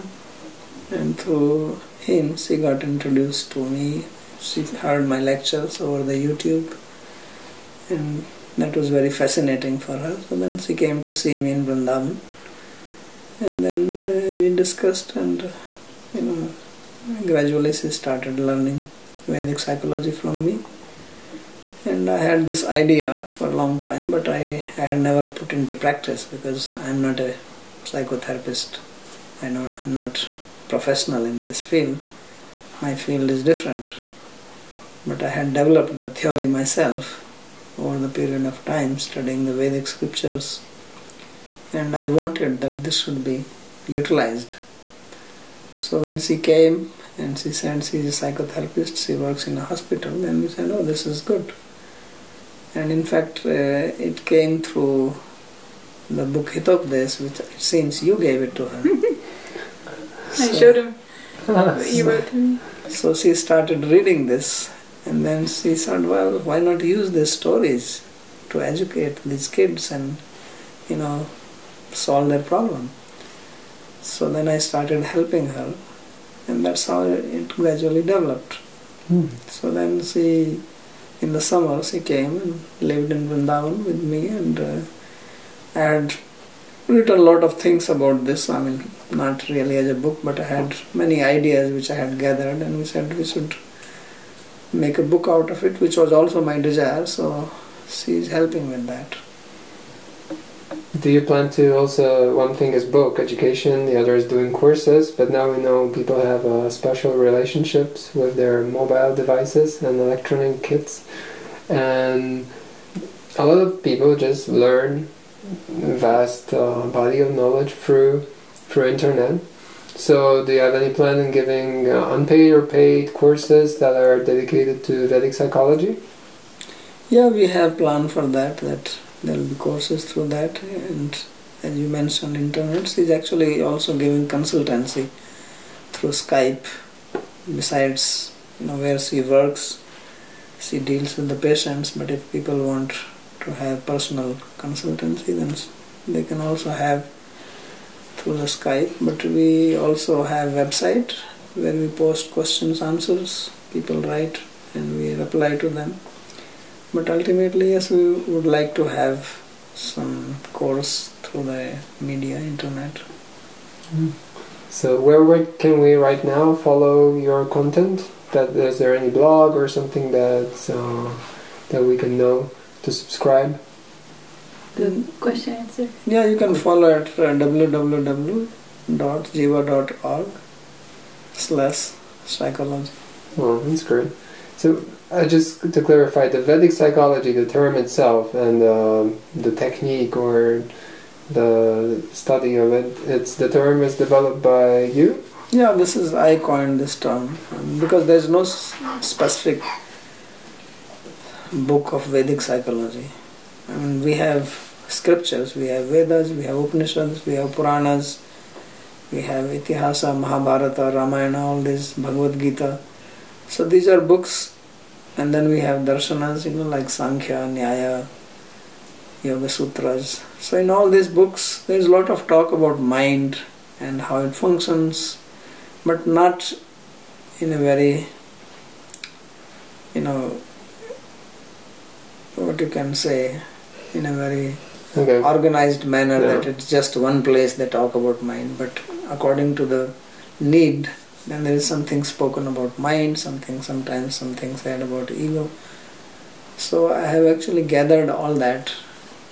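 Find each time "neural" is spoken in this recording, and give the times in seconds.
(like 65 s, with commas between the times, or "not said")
not said.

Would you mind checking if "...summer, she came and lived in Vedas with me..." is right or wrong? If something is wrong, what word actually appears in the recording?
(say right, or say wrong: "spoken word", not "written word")
wrong: "Vrindavan", not "Vedas".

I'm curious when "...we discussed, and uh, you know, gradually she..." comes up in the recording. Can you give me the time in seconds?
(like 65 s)
14 s.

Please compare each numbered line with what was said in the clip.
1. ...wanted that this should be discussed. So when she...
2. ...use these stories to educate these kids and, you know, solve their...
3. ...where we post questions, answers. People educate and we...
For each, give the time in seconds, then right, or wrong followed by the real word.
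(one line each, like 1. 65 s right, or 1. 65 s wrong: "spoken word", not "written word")
1. 42 s wrong: "utilized", not "discussed"
2. 66 s right
3. 151 s wrong: "write", not "educate".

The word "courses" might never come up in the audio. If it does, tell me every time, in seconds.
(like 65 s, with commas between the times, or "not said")
104 s, 123 s, 129 s, 160 s.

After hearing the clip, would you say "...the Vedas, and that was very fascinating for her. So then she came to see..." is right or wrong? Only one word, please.
wrong.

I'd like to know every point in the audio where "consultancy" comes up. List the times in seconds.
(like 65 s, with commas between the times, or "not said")
134 s, 144 s.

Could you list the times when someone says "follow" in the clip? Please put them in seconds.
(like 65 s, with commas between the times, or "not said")
166 s, 176 s.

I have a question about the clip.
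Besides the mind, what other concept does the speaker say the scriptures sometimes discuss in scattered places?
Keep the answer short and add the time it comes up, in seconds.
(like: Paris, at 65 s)
ego, at 245 s.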